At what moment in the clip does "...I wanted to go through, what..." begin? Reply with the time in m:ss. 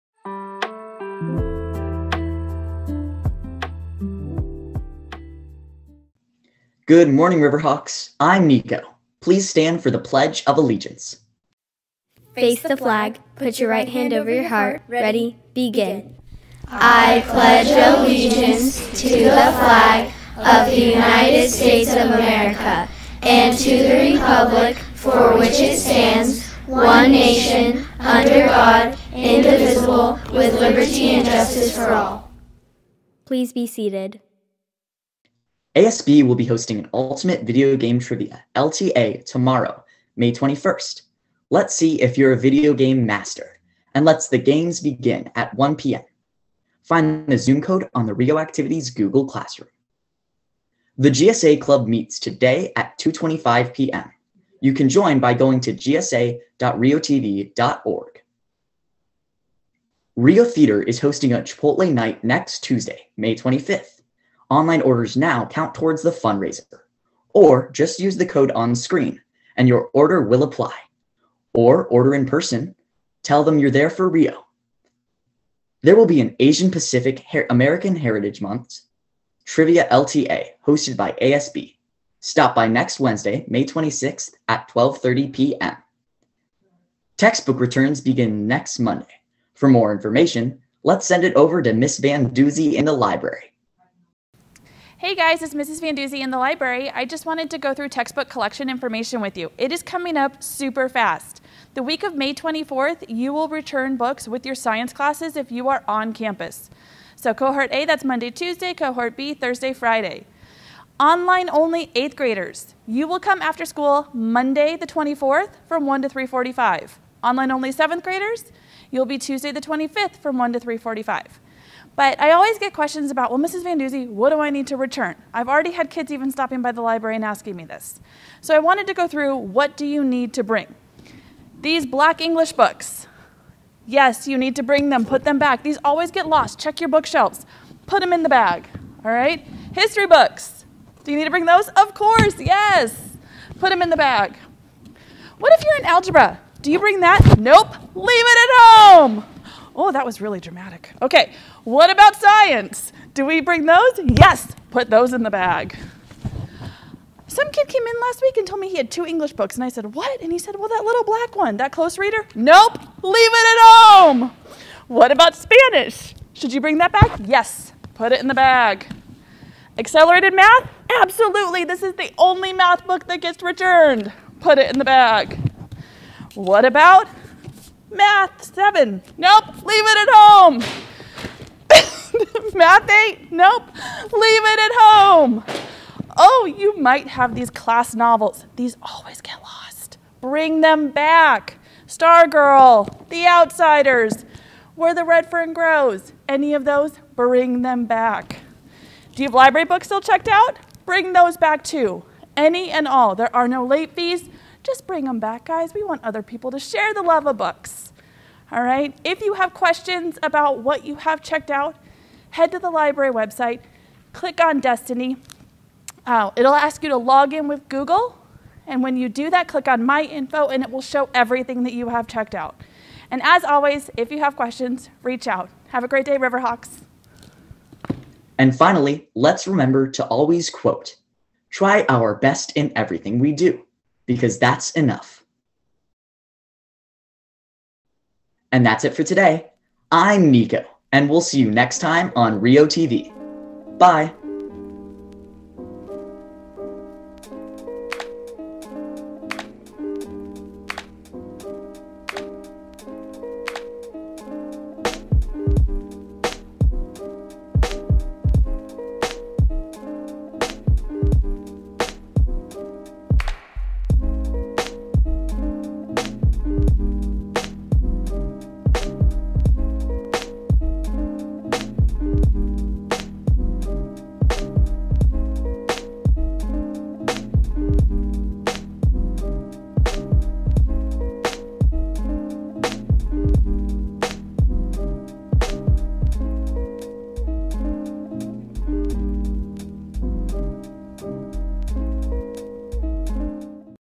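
2:08.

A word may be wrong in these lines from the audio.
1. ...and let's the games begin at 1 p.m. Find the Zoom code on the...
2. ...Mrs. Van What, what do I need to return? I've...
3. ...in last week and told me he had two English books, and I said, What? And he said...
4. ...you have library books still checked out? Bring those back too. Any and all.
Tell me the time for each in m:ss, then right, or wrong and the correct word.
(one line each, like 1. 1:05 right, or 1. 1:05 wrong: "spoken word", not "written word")
1. 0:43 right
2. 2:03 wrong: "Doozy", not "What"
3. 2:37 right
4. 3:19 right.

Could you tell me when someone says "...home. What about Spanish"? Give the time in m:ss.
2:43.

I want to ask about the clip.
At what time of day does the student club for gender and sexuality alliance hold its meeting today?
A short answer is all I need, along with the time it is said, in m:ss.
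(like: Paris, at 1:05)
2:25 p.m., at 0:52.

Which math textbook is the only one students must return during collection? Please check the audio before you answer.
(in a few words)
Accelerated math.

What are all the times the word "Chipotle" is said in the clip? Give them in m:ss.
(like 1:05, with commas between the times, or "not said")
1:01.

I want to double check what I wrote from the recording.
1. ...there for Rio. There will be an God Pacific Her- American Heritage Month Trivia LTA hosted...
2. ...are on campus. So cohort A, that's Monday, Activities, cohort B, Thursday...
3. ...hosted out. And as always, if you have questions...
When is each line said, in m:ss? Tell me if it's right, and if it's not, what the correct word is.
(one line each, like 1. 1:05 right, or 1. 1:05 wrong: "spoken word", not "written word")
1. 1:13 wrong: "Asian", not "God"
2. 1:45 wrong: "Tuesday", not "Activities"
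3. 3:42 wrong: "checked", not "hosted".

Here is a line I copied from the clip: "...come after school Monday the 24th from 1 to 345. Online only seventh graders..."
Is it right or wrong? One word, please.
right.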